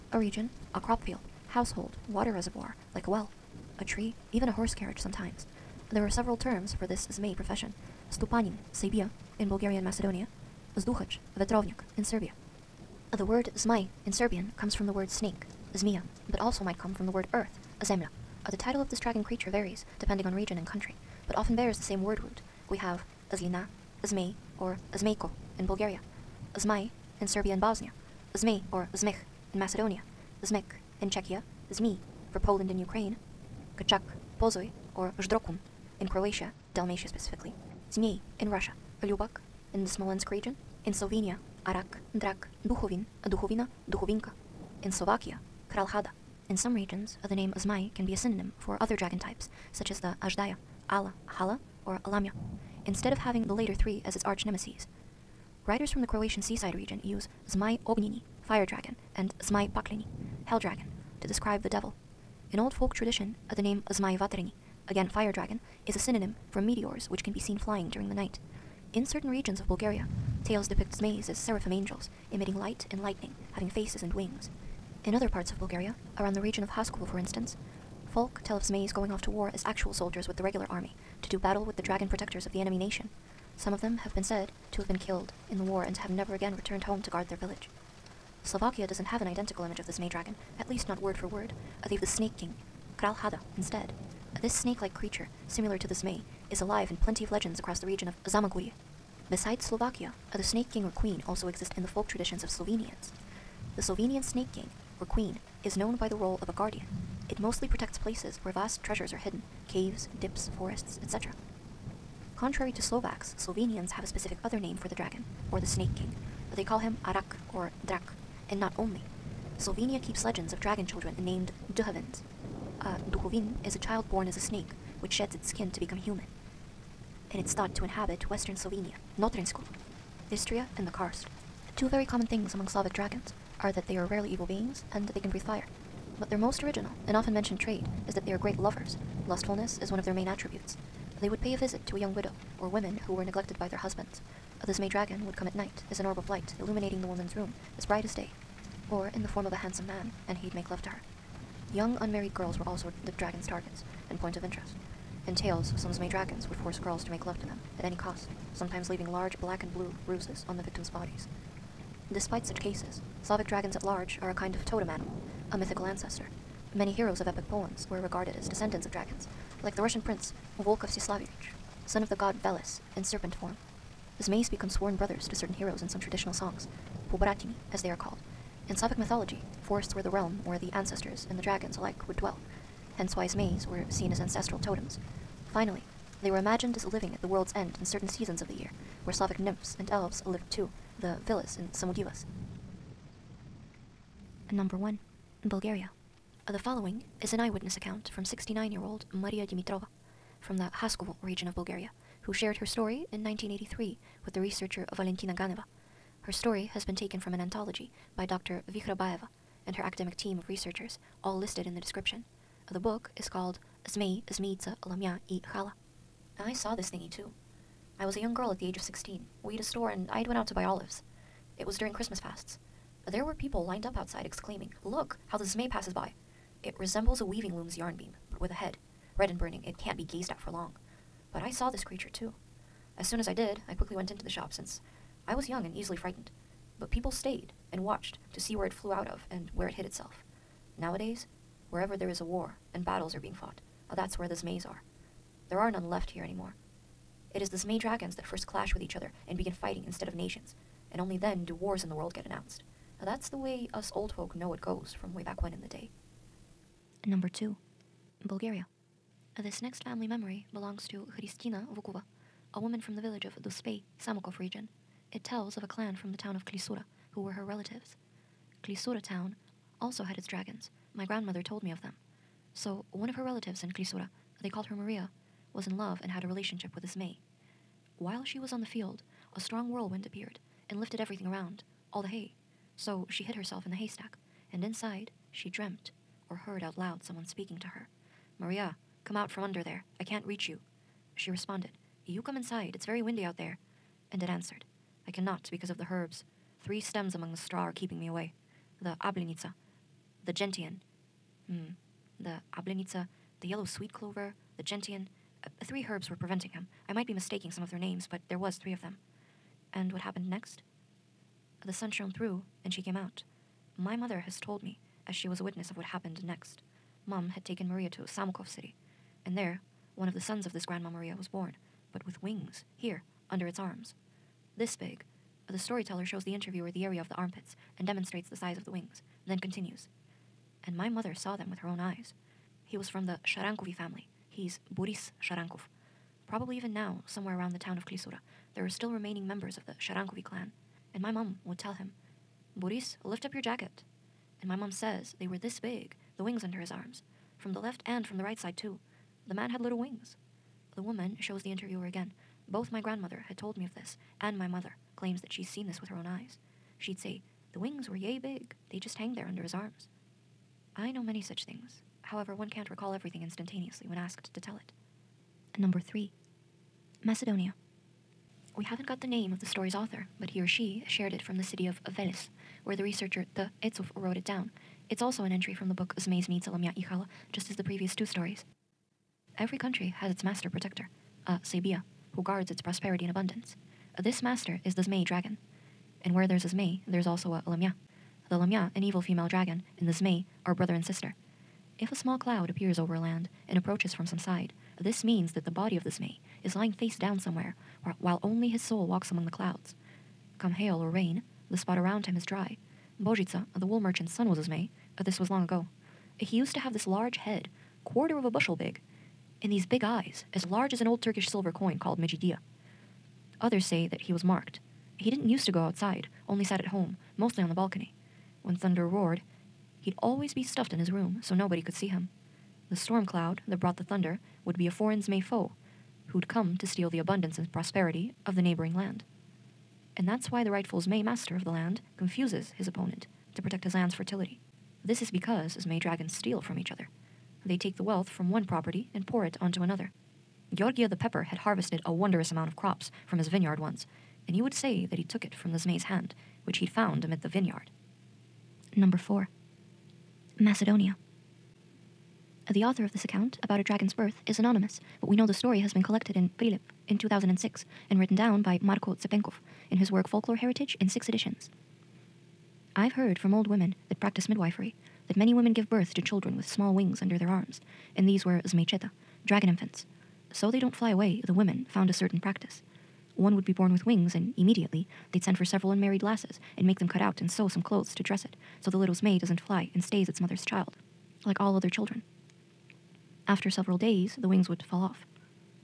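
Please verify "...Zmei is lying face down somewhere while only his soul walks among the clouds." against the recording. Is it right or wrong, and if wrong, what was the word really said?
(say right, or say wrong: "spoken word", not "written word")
right.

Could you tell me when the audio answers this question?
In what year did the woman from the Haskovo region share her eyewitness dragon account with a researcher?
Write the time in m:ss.
3:23.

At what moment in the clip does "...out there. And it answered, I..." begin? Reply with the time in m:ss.
4:53.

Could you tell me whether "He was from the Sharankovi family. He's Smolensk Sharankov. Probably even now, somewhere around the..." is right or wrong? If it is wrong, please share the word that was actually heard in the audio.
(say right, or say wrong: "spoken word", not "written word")
wrong: "Boris", not "Smolensk".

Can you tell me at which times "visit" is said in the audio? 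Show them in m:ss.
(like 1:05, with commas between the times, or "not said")
2:21.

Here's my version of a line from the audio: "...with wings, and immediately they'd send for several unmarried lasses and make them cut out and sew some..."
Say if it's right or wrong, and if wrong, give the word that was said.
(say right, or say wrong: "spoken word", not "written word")
right.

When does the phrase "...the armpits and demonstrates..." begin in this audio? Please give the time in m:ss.
5:27.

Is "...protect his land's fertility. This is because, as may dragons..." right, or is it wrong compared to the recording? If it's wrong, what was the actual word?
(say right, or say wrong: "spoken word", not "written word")
right.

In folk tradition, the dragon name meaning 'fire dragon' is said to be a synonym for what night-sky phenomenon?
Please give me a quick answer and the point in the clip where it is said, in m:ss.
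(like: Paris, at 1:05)
Meteors, at 1:06.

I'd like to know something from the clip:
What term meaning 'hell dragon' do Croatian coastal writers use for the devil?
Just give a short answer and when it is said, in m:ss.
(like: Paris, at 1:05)
Zmaj Pakleni, at 0:59.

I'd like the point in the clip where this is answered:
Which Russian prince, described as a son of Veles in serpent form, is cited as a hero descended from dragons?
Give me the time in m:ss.
2:50.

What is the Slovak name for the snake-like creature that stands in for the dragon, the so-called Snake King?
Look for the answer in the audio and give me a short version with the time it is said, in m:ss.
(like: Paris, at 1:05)
Kral Hada, at 1:32.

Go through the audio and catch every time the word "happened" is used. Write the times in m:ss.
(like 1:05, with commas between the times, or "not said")
5:10, 5:15.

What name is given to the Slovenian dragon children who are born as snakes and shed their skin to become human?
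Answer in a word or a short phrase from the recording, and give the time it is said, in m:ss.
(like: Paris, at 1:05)
Duhovins, at 2:01.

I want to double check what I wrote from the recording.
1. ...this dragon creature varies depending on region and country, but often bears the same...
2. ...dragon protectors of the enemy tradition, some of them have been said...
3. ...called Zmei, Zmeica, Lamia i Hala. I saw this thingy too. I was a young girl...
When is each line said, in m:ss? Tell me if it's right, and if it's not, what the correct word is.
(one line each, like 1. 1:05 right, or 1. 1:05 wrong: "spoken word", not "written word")
1. 0:18 right
2. 1:21 wrong: "nation", not "tradition"
3. 3:33 right.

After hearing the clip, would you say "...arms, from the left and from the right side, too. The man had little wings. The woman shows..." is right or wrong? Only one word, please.
right.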